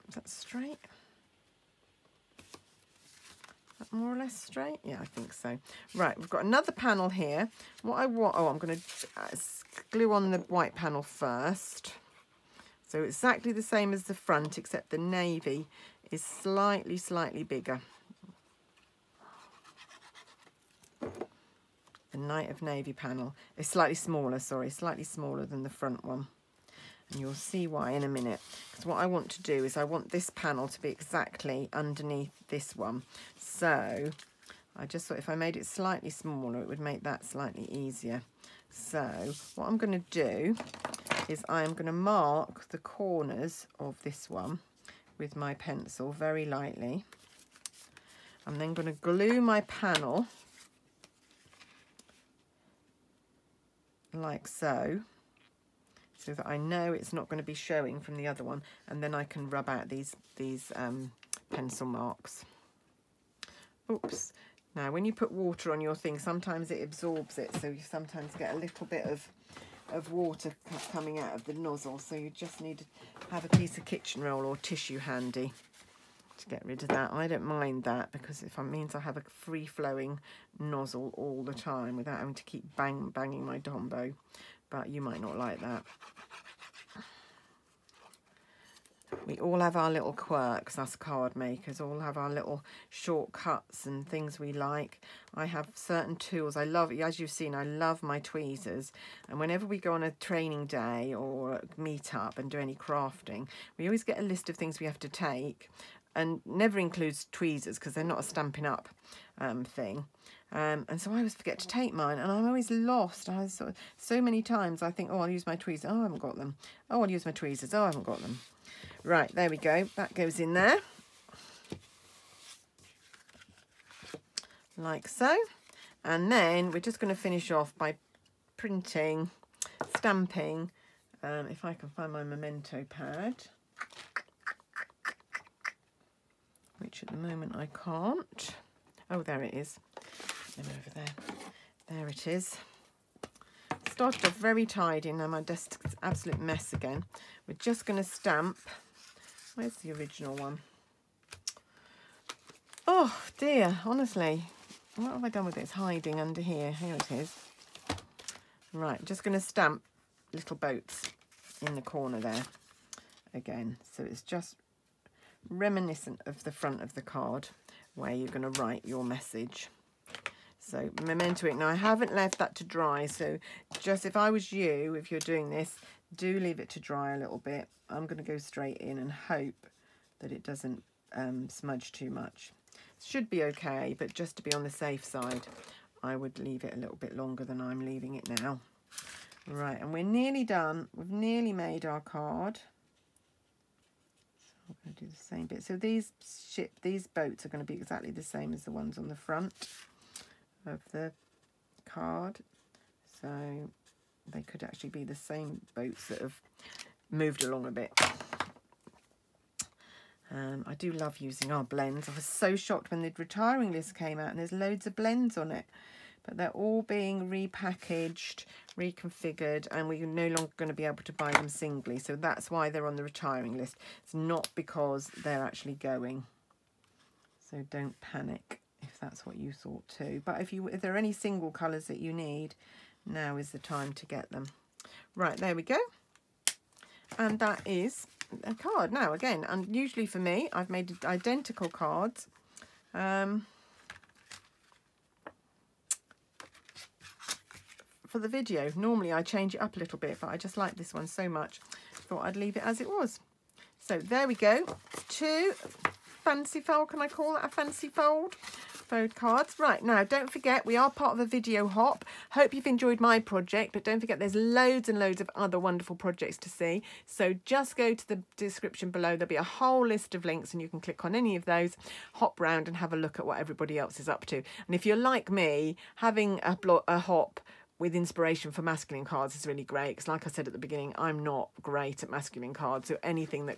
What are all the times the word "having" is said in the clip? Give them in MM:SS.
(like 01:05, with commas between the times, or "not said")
01:22, 04:35.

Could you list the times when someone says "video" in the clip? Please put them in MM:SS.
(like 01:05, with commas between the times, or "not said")
04:08, 04:21.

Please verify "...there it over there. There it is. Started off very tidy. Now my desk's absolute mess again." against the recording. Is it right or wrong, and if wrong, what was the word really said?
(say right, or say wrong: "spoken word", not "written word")
right.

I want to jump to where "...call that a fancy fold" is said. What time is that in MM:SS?
04:17.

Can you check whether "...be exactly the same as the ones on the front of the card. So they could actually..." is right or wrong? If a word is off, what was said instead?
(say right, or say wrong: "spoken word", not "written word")
right.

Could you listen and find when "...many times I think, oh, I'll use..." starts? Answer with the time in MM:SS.
01:54.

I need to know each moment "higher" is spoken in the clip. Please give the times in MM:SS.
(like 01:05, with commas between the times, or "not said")
not said.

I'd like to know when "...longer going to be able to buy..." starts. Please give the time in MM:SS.
03:40.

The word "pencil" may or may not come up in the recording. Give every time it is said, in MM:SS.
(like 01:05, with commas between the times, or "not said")
00:45, 01:01.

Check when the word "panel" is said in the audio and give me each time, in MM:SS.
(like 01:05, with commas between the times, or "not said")
00:06, 00:10, 00:22, 00:30, 00:49.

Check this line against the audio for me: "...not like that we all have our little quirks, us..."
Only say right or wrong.
right.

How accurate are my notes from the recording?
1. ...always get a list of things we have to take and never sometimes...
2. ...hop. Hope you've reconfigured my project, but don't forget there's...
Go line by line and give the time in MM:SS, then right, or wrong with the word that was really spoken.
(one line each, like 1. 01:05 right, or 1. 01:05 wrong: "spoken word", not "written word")
1. 01:43 wrong: "includes", not "sometimes"
2. 04:21 wrong: "enjoyed", not "reconfigured".